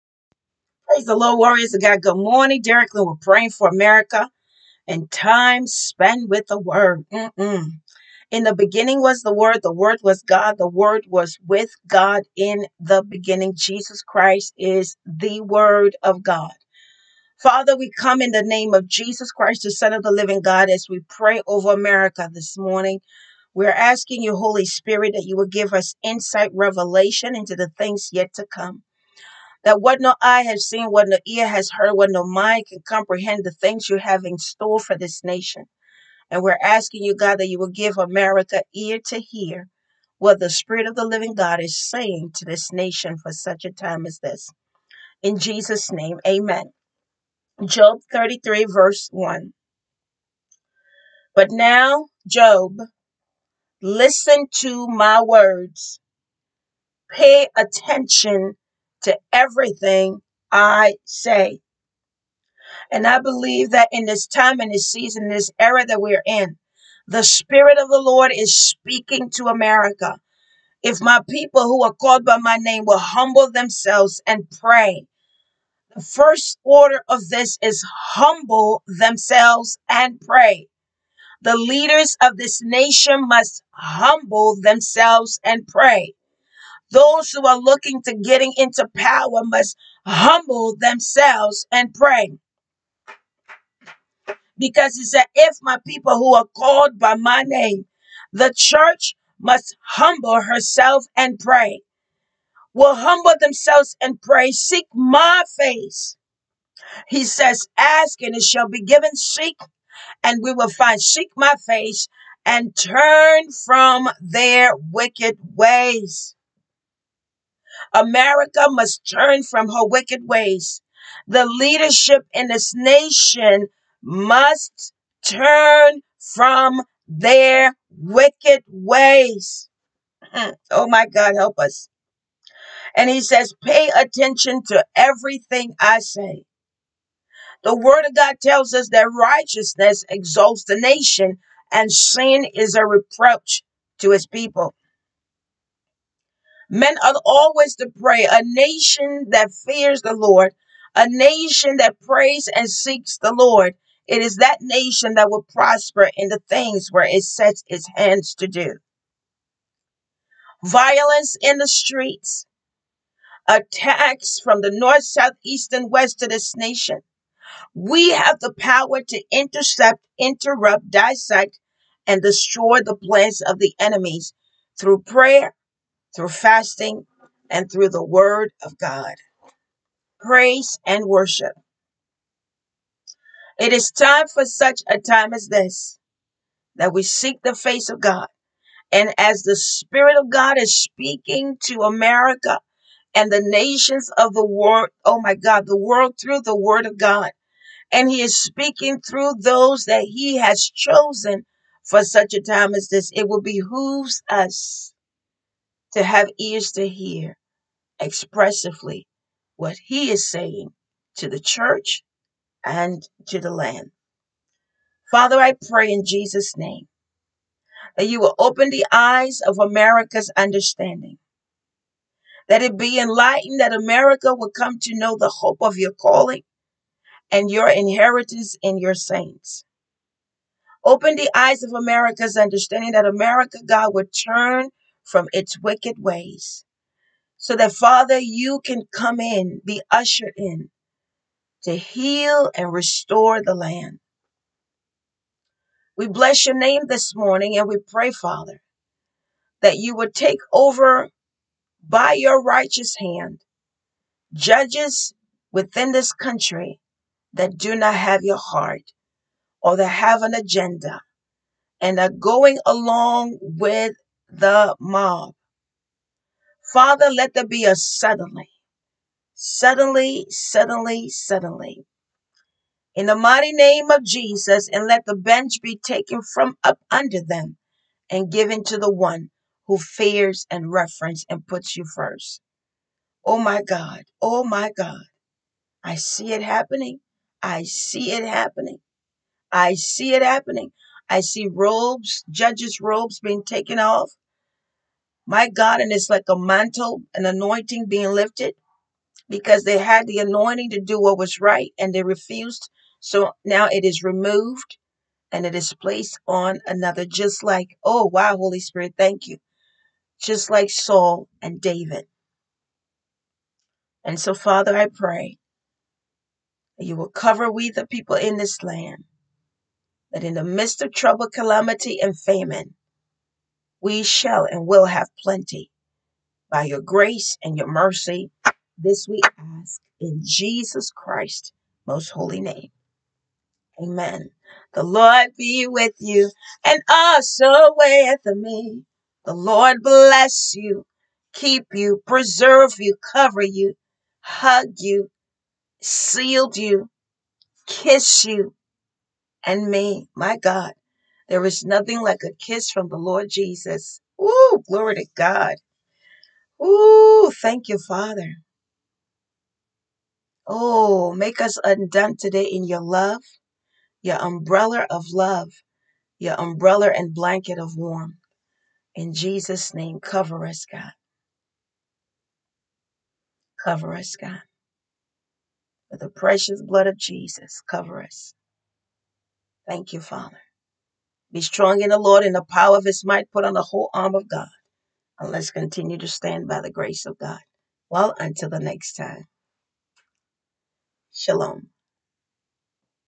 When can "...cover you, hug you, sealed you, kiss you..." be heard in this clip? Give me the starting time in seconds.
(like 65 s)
343 s.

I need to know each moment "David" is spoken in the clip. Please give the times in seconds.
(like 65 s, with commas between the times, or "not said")
311 s.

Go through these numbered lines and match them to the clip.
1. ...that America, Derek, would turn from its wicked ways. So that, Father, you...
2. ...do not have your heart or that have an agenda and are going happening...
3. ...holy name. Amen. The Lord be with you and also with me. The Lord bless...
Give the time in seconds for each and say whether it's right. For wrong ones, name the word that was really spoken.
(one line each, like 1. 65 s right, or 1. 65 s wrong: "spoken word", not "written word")
1. 232 s wrong: "God", not "Derek"
2. 257 s wrong: "along", not "happening"
3. 332 s right.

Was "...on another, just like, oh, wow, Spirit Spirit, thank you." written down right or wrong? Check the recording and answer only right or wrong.
wrong.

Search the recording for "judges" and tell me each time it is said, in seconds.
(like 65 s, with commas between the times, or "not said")
254 s, 292 s.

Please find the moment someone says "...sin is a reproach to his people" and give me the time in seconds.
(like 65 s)
141 s.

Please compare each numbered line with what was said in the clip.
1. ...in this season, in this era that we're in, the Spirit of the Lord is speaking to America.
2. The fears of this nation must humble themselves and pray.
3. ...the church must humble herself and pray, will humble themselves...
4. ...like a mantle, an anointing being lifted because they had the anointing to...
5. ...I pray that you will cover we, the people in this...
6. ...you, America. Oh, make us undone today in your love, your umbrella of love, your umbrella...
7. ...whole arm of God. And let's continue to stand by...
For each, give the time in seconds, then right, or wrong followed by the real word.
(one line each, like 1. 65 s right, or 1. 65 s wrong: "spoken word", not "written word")
1. 64 s right
2. 81 s wrong: "leaders", not "fears"
3. 98 s right
4. 296 s right
5. 314 s right
6. 357 s wrong: "Father", not "America"
7. 383 s right.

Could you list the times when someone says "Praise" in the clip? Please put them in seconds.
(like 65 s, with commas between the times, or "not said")
1 s, 180 s.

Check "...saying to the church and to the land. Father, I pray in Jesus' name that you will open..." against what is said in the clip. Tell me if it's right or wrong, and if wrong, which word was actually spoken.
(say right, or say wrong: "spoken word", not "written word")
right.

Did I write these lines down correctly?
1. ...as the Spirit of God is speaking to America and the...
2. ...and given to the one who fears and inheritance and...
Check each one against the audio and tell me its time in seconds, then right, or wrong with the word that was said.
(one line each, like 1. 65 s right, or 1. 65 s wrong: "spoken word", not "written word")
1. 189 s right
2. 278 s wrong: "reverence", not "inheritance".